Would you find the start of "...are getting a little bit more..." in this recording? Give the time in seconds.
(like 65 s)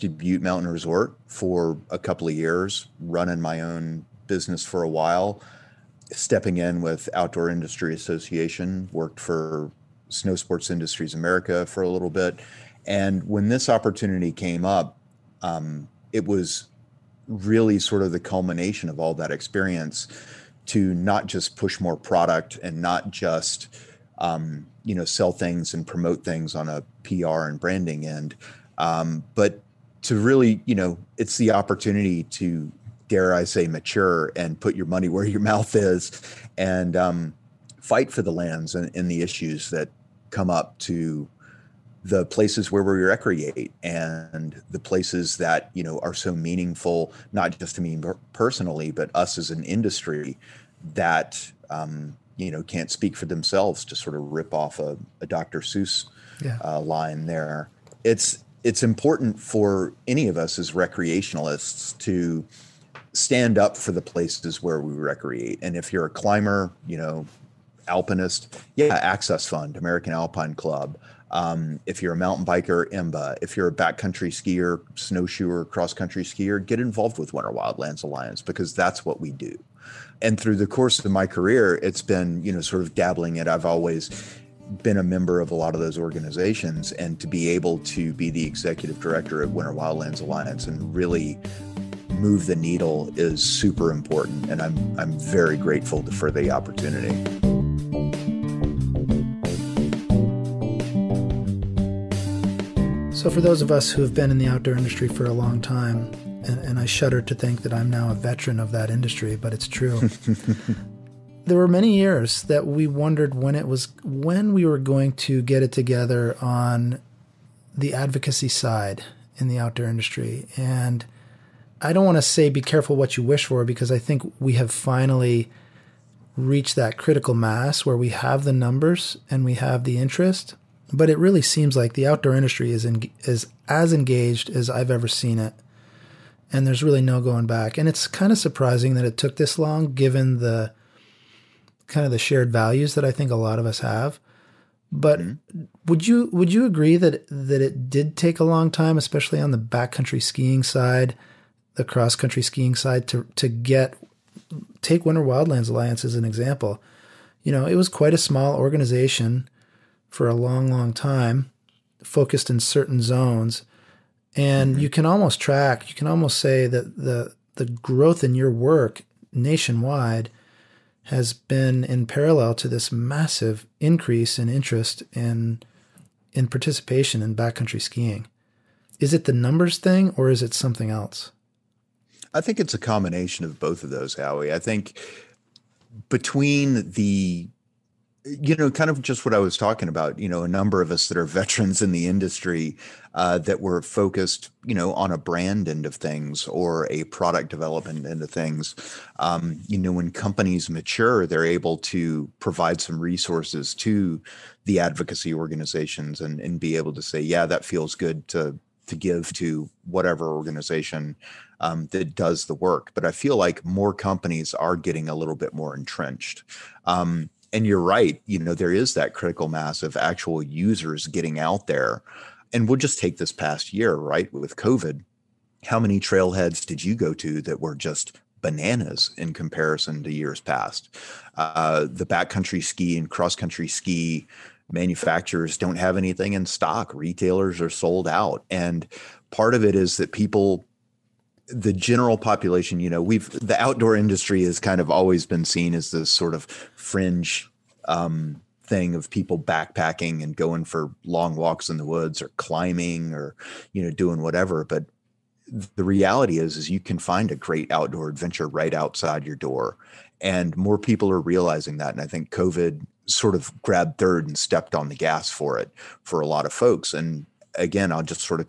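214 s.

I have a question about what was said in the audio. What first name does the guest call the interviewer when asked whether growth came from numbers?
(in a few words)
Howie.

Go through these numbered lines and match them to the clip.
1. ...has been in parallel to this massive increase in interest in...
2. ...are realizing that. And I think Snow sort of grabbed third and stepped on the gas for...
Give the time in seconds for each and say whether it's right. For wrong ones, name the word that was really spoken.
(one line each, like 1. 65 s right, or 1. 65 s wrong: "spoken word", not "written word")
1. 171 s right
2. 261 s wrong: "COVID", not "Snow".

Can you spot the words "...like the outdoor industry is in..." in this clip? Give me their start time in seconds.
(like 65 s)
131 s.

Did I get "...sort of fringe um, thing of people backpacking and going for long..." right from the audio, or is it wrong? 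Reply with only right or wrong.
right.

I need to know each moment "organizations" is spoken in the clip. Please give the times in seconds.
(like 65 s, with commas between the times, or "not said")
85 s, 158 s, 205 s, 210 s.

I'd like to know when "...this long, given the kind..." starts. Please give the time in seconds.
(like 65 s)
139 s.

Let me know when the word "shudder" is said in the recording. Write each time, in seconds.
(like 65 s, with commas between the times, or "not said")
106 s.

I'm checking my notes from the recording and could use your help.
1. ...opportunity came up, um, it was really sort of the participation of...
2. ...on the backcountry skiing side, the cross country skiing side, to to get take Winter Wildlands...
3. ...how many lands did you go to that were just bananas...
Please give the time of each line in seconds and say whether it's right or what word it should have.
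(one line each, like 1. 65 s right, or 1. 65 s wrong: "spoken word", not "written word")
1. 13 s wrong: "culmination", not "participation"
2. 149 s right
3. 225 s wrong: "trailheads", not "lands".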